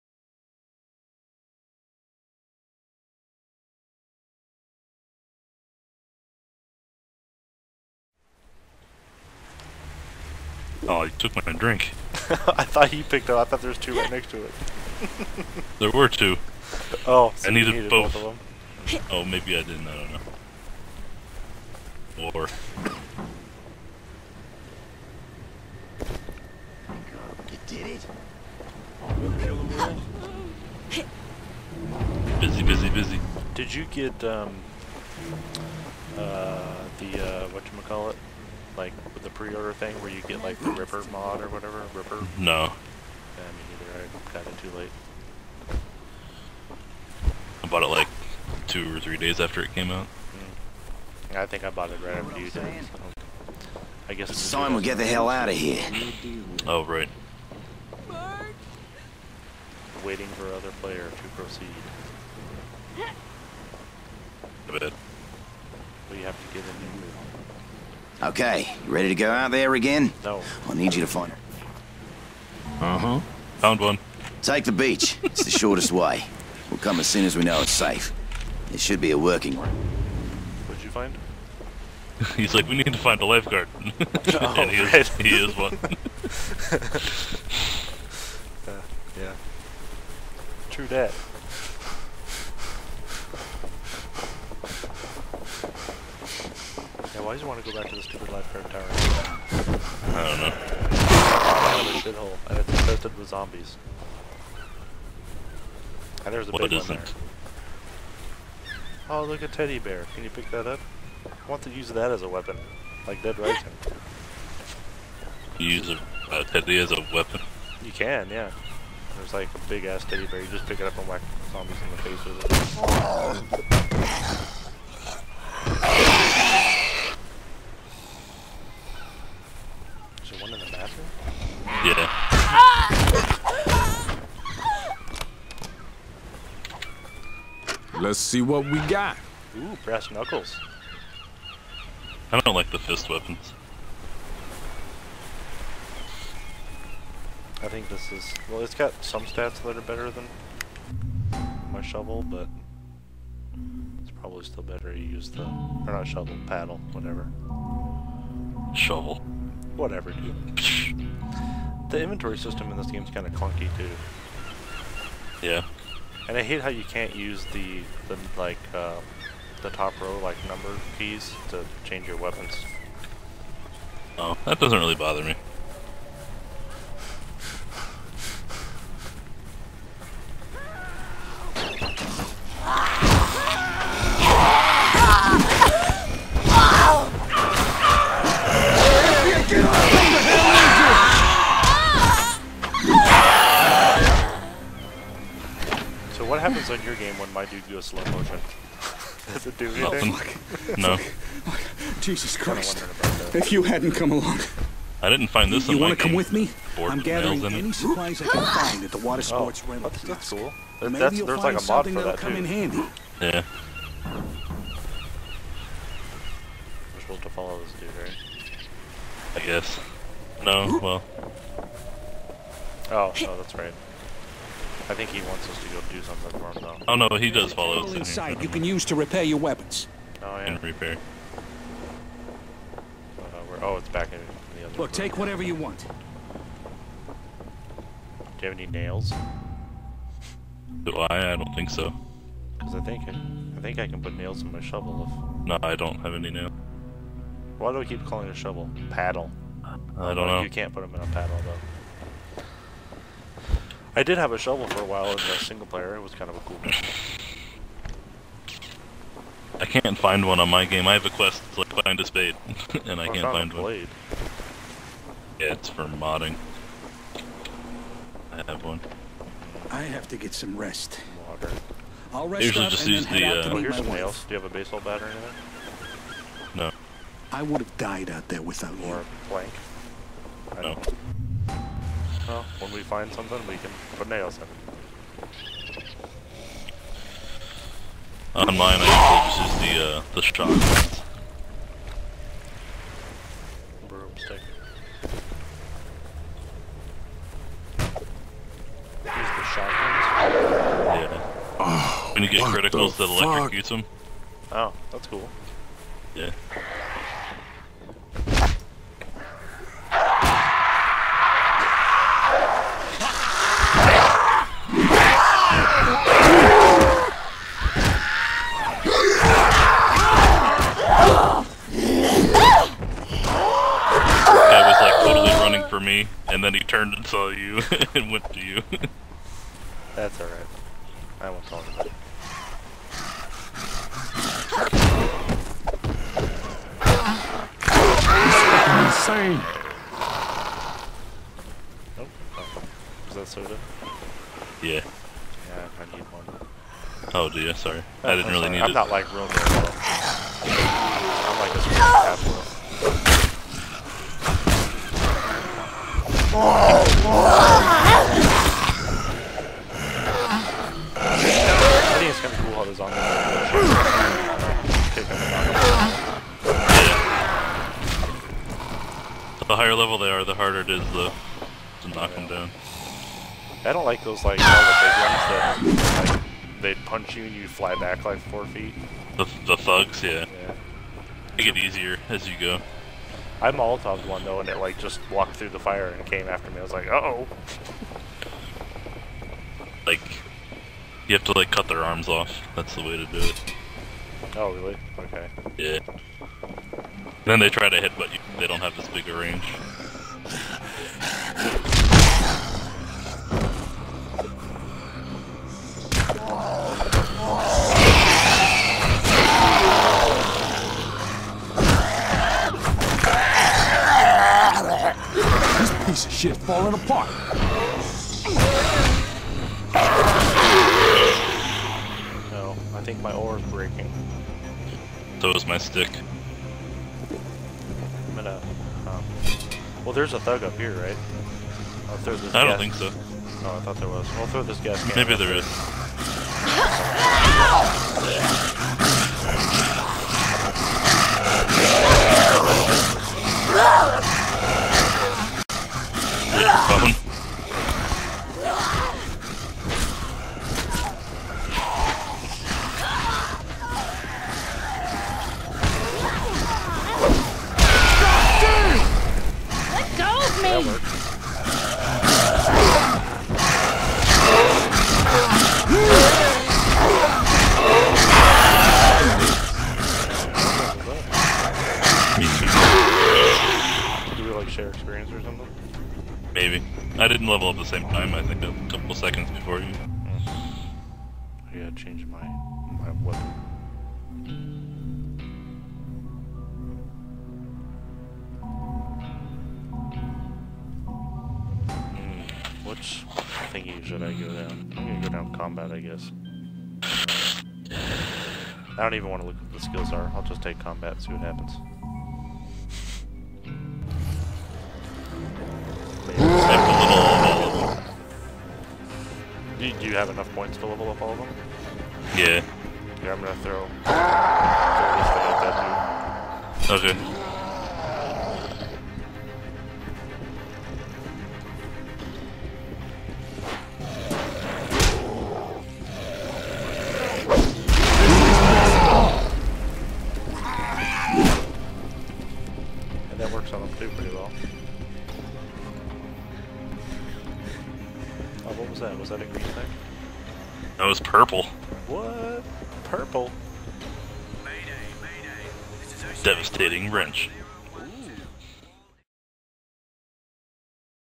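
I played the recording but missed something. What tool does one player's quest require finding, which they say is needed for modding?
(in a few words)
A spade.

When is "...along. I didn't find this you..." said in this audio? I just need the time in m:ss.
3:24.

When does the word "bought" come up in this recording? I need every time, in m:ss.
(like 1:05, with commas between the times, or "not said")
0:47, 0:51.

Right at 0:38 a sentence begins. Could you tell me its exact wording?
Like with the pre-order thing where you get like the Ripper mod or whatever?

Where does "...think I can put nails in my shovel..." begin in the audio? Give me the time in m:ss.
4:03.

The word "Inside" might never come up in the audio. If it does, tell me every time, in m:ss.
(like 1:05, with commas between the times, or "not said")
3:47.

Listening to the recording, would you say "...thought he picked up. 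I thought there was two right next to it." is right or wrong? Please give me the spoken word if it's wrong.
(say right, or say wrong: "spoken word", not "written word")
right.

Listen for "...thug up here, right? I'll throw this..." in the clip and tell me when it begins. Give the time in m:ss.
7:10.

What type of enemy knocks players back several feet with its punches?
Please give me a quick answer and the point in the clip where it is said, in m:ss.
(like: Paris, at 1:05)
Thugs, at 6:19.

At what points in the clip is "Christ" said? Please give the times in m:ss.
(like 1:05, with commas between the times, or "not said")
3:22.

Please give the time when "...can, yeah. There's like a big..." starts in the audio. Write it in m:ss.
1:57.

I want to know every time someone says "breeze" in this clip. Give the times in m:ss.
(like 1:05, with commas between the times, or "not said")
not said.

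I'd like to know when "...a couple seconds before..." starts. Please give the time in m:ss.
7:58.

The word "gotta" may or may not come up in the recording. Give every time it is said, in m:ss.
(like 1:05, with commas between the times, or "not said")
8:01.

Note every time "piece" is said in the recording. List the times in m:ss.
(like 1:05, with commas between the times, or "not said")
6:55.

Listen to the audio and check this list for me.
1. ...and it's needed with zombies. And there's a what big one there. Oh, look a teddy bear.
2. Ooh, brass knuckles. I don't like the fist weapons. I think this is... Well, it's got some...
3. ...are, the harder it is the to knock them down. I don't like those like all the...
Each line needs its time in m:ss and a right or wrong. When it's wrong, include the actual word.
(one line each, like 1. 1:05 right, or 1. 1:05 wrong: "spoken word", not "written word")
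1. 1:42 wrong: "infested", not "needed"
2. 2:19 right
3. 6:10 right.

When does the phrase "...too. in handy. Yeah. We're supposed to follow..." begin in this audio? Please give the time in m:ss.
3:32.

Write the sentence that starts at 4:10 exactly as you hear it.
You can't put them in a paddle though.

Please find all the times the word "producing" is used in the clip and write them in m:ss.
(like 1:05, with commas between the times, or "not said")
not said.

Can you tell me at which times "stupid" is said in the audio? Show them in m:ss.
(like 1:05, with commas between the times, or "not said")
1:38.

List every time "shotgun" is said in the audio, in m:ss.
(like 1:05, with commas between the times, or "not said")
4:50, 4:59.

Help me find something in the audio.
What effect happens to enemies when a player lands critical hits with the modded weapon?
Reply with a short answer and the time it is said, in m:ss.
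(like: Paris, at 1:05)
Electrocutes them, at 5:03.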